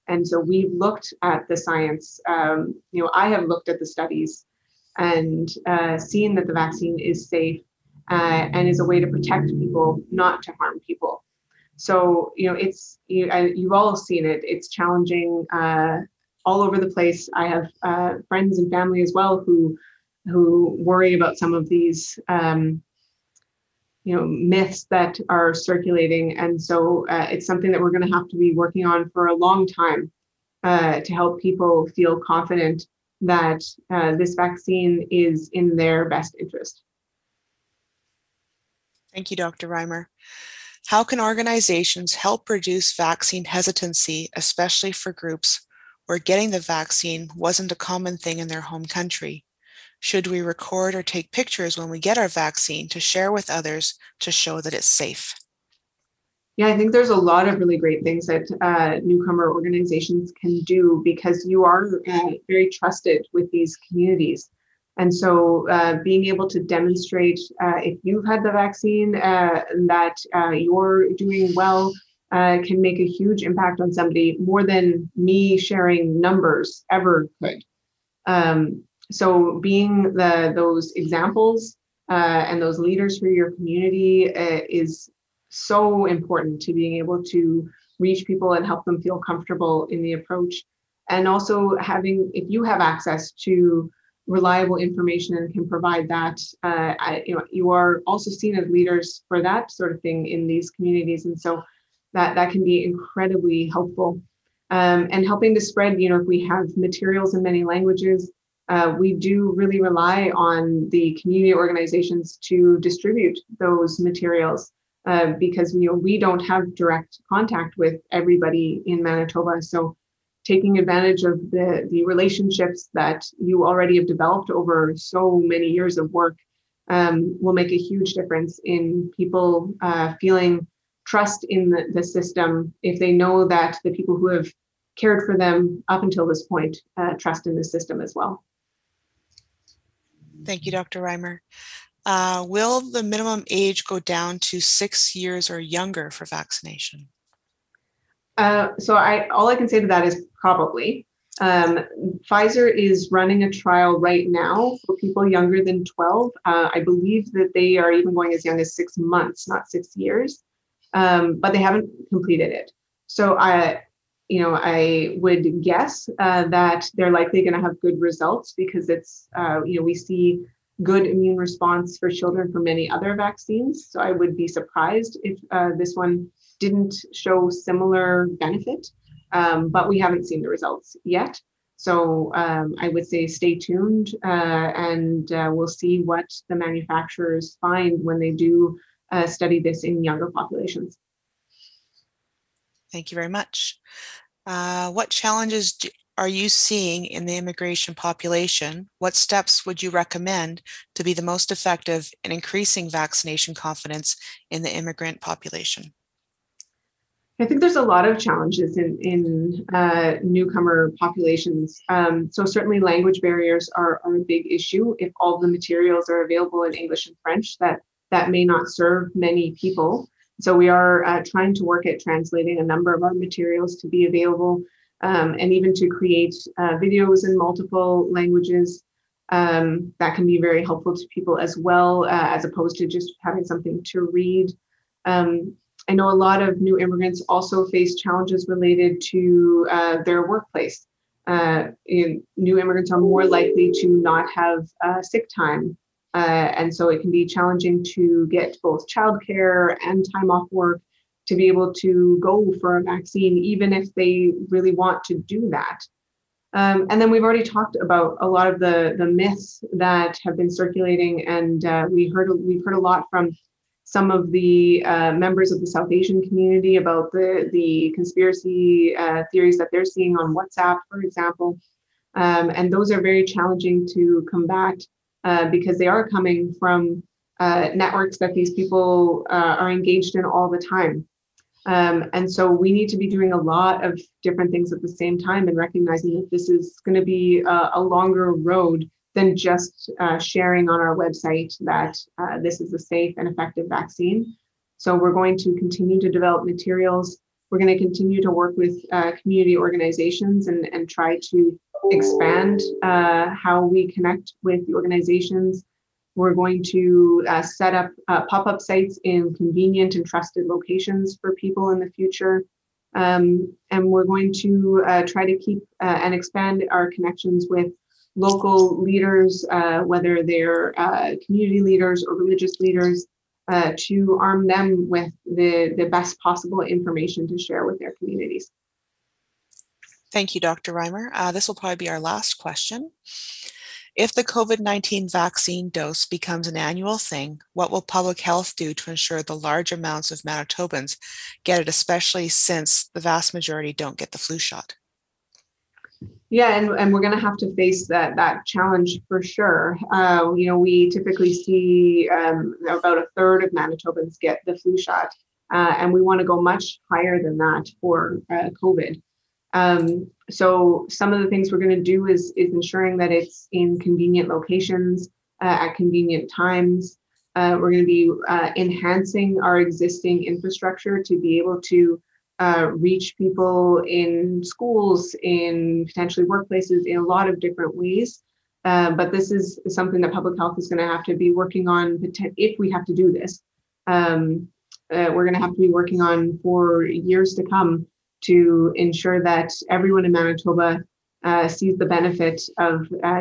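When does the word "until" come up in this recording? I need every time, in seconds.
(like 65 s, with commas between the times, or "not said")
136 s.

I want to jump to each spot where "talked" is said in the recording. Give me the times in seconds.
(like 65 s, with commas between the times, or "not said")
257 s.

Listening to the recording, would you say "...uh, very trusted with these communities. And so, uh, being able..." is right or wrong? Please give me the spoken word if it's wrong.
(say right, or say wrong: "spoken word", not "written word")
right.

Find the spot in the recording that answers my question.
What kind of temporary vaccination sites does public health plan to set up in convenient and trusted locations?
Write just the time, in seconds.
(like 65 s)
308 s.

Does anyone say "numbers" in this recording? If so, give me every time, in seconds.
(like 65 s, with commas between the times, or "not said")
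76 s, 222 s.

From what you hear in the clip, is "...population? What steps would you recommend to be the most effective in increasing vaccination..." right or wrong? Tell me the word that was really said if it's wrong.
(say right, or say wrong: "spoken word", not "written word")
right.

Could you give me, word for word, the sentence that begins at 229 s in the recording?
Um, that can be very helpful to people as well, uh, as opposed to just having something to read.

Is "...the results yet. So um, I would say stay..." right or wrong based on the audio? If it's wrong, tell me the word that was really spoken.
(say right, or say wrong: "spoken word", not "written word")
right.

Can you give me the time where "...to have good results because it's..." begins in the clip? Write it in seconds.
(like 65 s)
167 s.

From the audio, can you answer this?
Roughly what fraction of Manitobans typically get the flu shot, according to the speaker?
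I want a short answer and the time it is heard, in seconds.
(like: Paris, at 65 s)
A third, at 352 s.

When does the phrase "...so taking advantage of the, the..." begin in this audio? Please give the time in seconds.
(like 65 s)
119 s.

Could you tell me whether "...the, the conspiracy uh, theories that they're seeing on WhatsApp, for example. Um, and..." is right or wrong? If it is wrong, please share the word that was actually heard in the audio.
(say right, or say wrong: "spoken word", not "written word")
right.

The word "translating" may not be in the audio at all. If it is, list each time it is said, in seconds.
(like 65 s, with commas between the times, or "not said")
221 s.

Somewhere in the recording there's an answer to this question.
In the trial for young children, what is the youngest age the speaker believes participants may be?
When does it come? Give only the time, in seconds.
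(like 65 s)
158 s.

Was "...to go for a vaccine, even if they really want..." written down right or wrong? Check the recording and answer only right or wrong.
right.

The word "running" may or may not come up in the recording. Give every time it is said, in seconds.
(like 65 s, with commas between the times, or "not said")
153 s.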